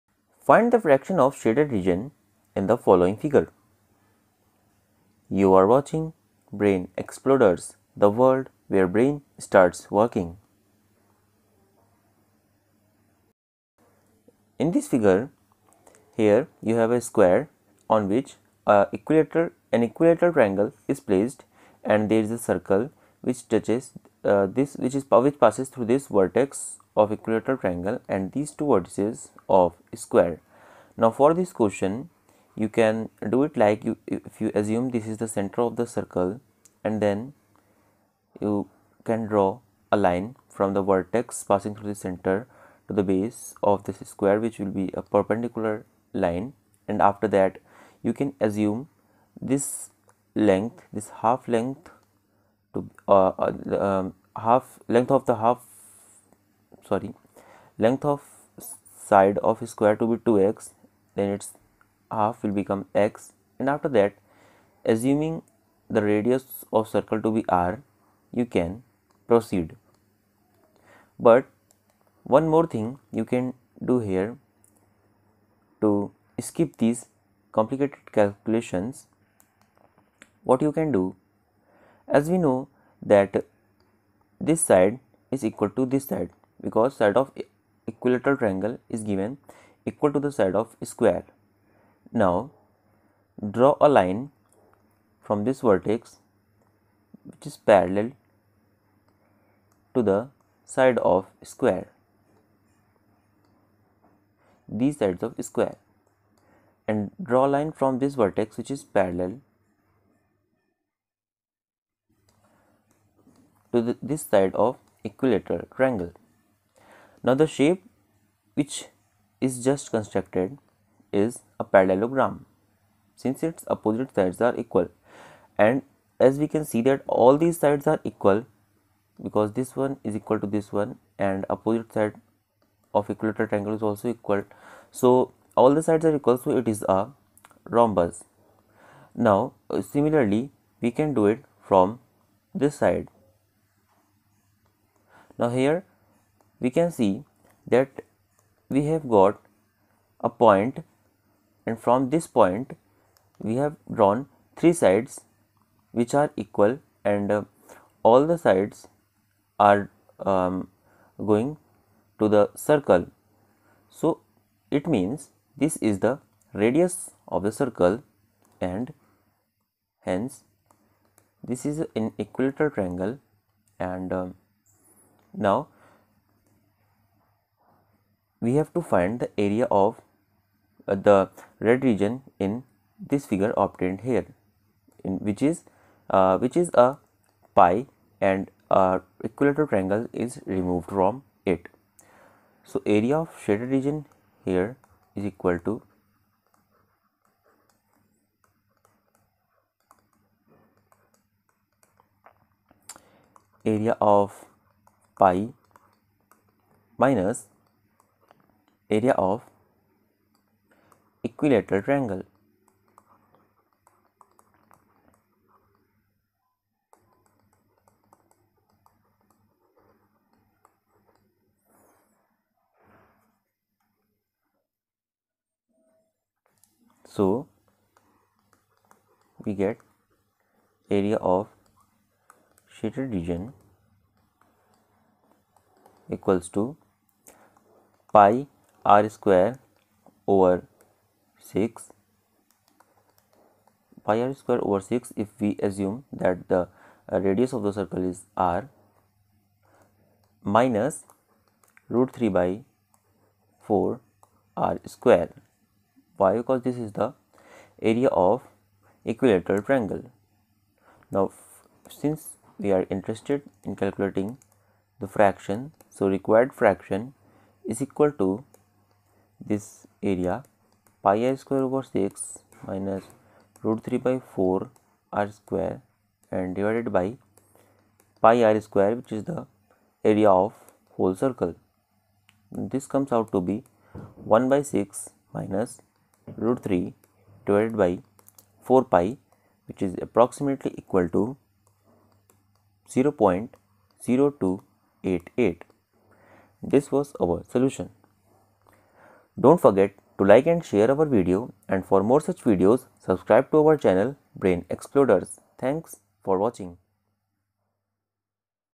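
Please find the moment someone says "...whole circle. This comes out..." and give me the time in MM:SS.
04:40.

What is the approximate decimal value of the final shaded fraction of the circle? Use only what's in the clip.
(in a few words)
0.0288.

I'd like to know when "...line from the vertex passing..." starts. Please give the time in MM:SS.
00:39.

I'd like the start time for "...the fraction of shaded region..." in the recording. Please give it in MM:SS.
00:00.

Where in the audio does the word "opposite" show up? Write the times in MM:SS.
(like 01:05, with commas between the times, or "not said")
02:03, 02:11.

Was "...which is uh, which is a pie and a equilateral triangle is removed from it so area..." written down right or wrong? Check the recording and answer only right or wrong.
right.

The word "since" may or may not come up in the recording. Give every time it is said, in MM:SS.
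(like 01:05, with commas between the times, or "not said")
02:03, 04:22.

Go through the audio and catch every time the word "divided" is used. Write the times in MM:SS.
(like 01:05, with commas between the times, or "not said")
04:36, 04:47.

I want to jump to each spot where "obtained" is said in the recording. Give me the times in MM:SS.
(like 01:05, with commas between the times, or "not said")
03:03.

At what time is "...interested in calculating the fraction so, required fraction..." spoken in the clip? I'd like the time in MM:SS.
04:22.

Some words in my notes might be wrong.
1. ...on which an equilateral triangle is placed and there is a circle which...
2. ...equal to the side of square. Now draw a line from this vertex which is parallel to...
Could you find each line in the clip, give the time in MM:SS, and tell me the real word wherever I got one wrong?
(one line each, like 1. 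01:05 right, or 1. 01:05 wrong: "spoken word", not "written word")
1. 00:17 right
2. 01:29 right.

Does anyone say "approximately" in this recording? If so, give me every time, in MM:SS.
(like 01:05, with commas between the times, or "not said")
04:50.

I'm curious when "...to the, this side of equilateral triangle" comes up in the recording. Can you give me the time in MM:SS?
01:53.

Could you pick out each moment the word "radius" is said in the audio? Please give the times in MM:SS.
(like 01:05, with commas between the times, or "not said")
01:06, 02:46, 04:07.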